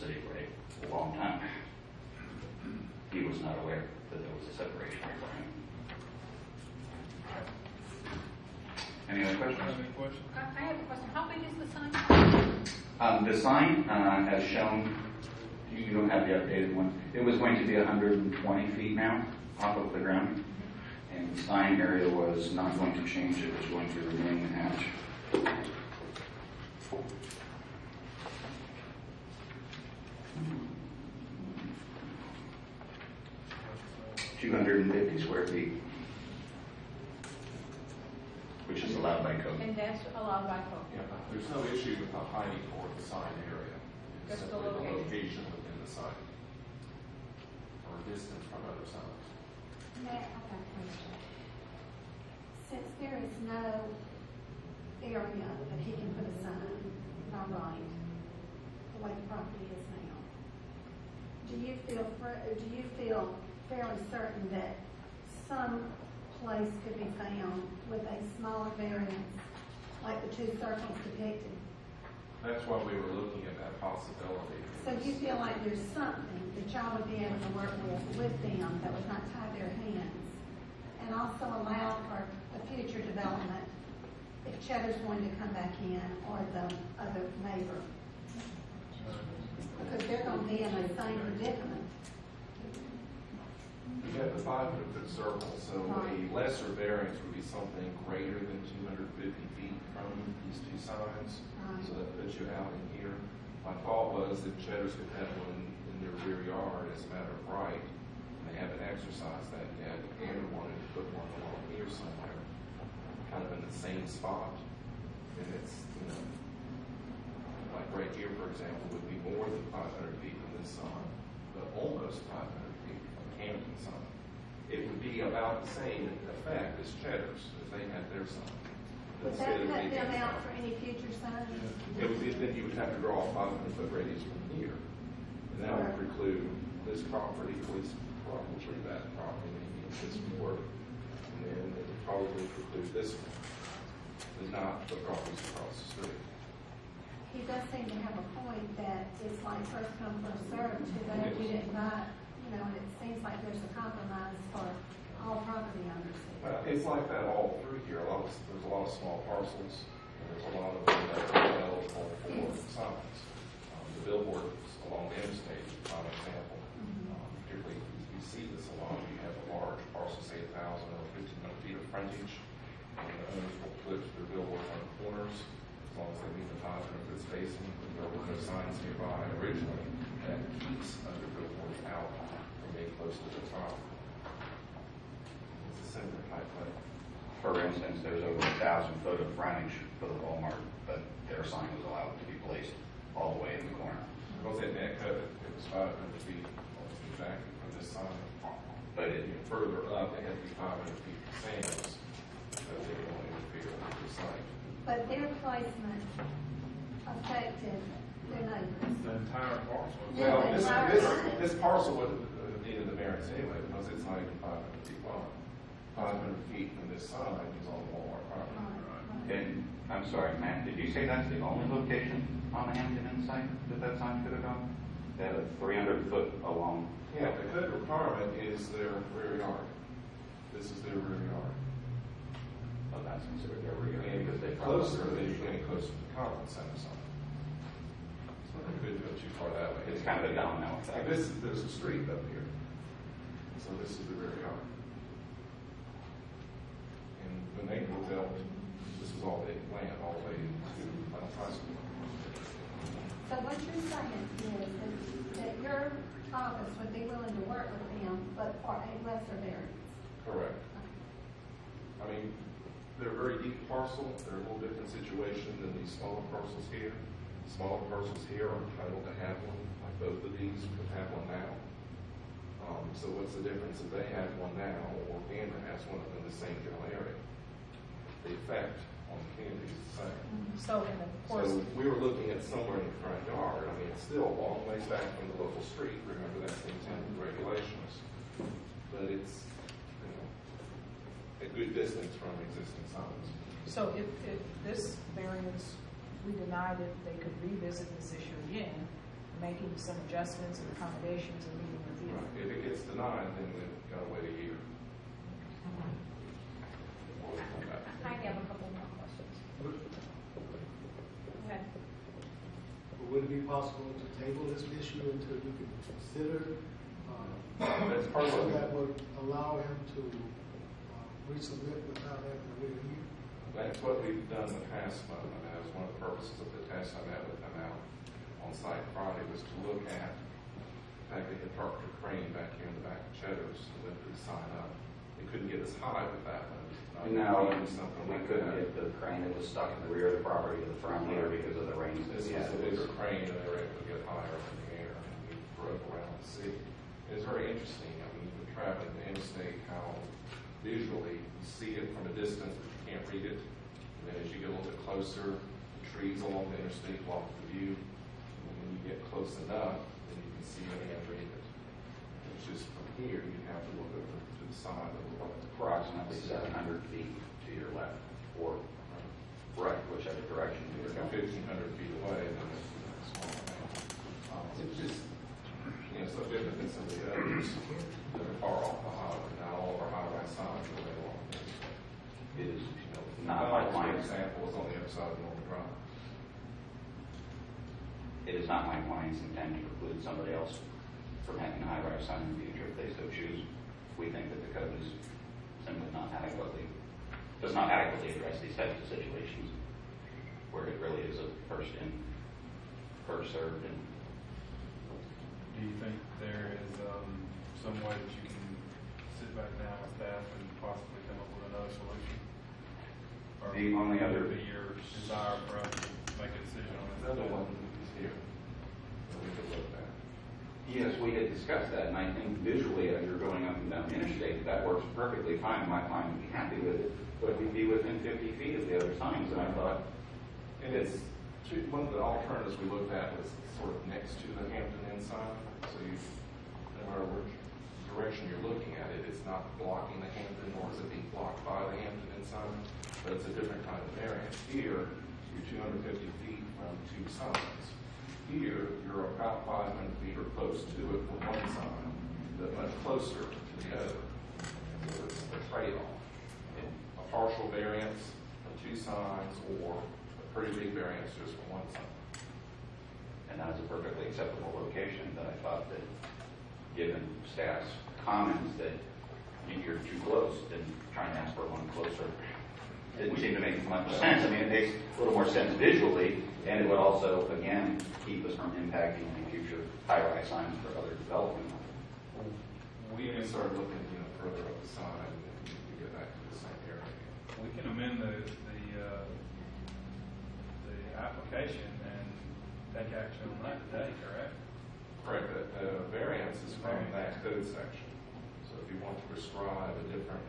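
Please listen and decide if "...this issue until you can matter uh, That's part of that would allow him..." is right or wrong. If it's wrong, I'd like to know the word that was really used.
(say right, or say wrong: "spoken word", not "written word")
wrong: "consider", not "matter".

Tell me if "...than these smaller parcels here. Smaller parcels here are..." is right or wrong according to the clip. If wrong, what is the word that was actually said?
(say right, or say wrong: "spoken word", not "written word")
right.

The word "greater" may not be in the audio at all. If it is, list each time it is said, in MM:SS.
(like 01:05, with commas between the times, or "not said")
01:38.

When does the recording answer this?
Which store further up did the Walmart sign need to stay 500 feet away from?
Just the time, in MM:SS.
03:21.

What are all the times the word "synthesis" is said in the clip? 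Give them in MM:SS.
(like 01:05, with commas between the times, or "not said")
not said.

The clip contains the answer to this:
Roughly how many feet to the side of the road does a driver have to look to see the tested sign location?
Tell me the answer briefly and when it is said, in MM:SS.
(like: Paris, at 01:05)
700 feet, at 06:06.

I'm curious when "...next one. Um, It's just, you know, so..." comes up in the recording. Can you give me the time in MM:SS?
06:12.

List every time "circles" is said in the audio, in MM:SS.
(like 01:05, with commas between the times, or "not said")
01:10, 01:35.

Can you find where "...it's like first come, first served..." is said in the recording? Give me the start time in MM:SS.
02:29.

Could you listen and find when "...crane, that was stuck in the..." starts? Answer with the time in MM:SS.
05:38.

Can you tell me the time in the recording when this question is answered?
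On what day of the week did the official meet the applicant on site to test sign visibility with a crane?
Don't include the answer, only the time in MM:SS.
05:28.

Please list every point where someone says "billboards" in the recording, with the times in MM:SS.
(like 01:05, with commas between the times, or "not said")
02:44, 02:54, 03:01.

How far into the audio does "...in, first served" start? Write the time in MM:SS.
06:41.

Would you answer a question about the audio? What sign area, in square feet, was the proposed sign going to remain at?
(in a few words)
250 square feet.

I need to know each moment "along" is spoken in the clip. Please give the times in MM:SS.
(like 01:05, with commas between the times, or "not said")
01:51, 02:44, 03:46, 05:56, 06:20.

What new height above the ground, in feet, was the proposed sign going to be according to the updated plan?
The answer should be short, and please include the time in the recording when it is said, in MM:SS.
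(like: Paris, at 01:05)
120 feet, at 00:17.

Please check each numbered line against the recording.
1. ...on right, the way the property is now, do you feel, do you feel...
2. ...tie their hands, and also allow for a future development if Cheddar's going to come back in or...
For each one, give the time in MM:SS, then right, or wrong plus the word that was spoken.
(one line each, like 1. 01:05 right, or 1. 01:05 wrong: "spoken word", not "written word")
1. 00:57 right
2. 01:19 right.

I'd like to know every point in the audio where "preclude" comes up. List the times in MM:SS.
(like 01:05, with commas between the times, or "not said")
02:15, 02:22, 06:29.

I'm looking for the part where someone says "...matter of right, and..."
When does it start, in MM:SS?
01:47.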